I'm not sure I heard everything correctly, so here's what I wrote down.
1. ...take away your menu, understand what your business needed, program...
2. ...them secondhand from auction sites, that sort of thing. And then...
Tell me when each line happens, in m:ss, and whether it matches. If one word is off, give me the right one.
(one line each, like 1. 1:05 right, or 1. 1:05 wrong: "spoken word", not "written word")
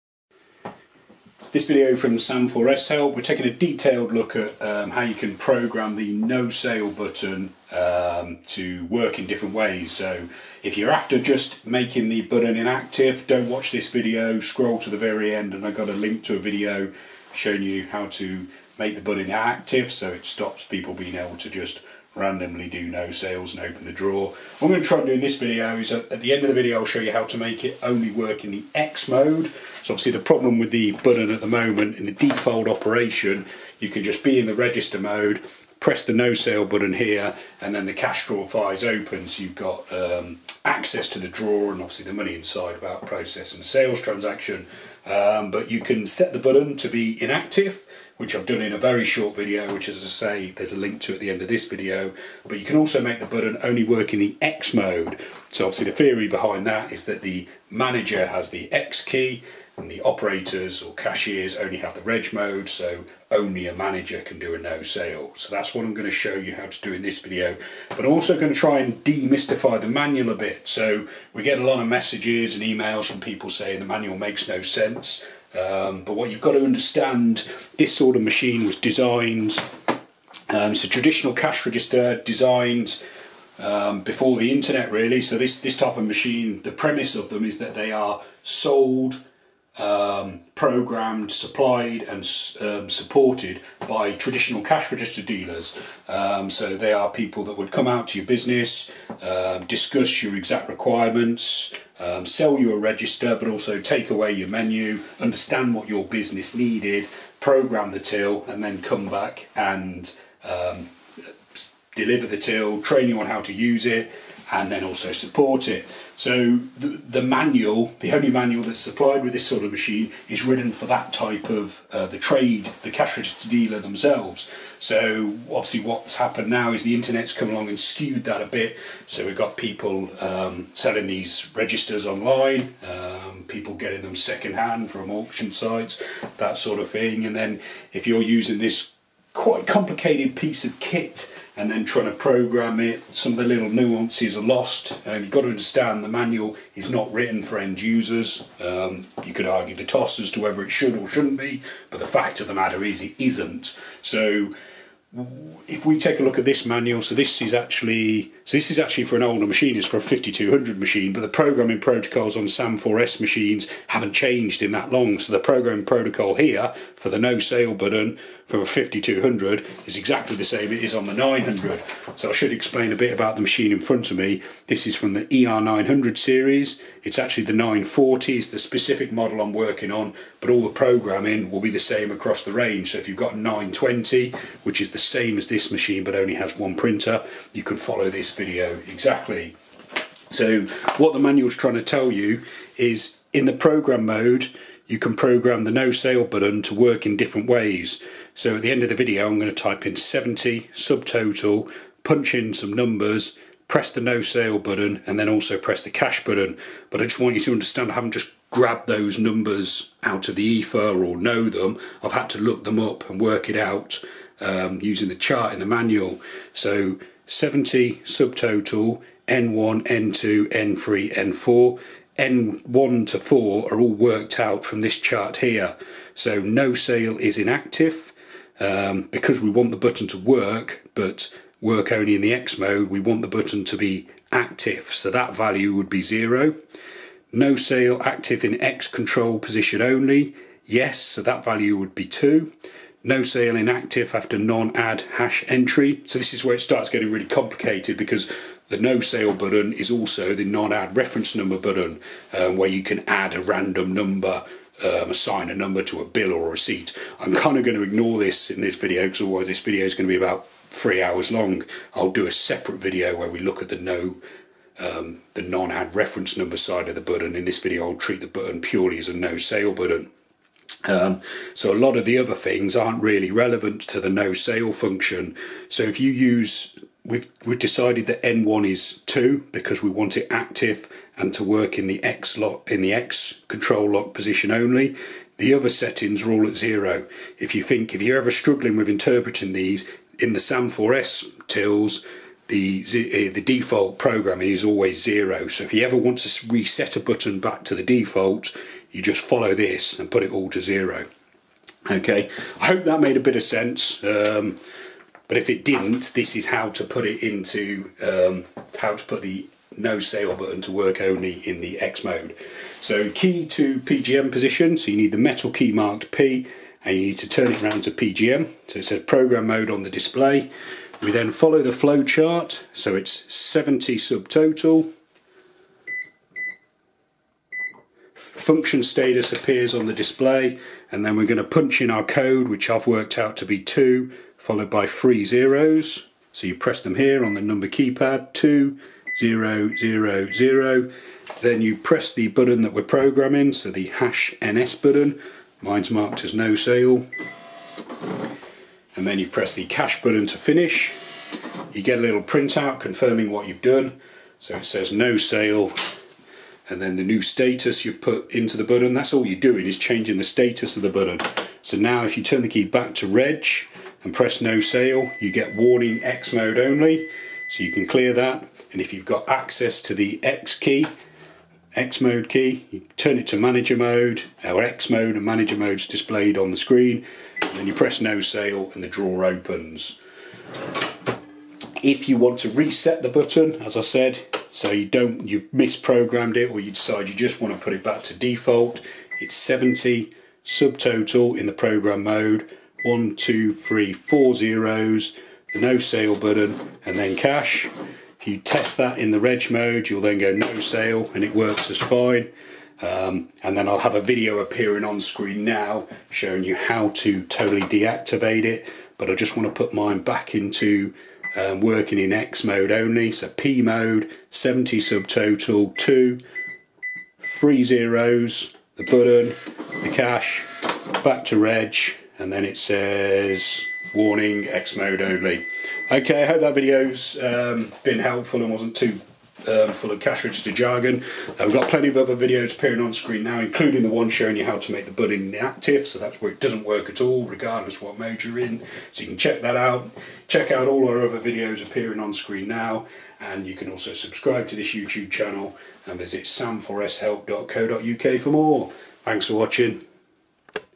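1. 1:43 right
2. 2:14 right.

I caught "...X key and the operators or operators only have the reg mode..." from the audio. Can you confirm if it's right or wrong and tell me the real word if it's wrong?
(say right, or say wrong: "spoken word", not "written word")
wrong: "cashiers", not "operators".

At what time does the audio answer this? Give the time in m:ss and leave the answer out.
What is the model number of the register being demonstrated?
2:57.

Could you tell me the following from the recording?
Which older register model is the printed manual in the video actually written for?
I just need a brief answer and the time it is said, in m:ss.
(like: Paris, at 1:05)
5200, at 2:40.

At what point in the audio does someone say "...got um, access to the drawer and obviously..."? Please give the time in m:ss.
0:39.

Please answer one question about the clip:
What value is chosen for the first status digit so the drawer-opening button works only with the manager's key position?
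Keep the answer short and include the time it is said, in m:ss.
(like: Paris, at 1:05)
2, at 4:01.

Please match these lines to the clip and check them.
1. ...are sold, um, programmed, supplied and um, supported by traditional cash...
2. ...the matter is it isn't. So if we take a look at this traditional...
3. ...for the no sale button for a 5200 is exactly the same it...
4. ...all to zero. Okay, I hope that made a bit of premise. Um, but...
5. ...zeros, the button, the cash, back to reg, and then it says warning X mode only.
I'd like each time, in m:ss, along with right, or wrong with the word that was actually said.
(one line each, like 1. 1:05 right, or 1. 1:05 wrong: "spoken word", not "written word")
1. 1:27 right
2. 2:32 wrong: "manual", not "traditional"
3. 2:46 right
4. 5:00 wrong: "sense", not "premise"
5. 6:57 right.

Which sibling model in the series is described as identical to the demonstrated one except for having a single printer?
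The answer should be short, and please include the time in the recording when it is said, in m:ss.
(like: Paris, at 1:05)
920, at 3:03.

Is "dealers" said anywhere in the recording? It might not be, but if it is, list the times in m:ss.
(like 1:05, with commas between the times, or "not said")
1:35, 2:03.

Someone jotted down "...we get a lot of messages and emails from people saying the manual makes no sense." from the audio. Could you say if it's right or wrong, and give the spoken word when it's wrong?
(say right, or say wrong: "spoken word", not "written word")
right.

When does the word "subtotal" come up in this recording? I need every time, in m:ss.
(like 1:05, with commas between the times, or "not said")
3:20, 3:38, 5:23, 6:30, 6:54.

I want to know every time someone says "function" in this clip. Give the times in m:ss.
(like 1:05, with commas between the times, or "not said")
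4:34, 5:28.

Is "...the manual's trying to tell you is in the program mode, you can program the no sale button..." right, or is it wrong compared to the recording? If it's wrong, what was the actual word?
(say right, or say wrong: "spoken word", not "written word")
right.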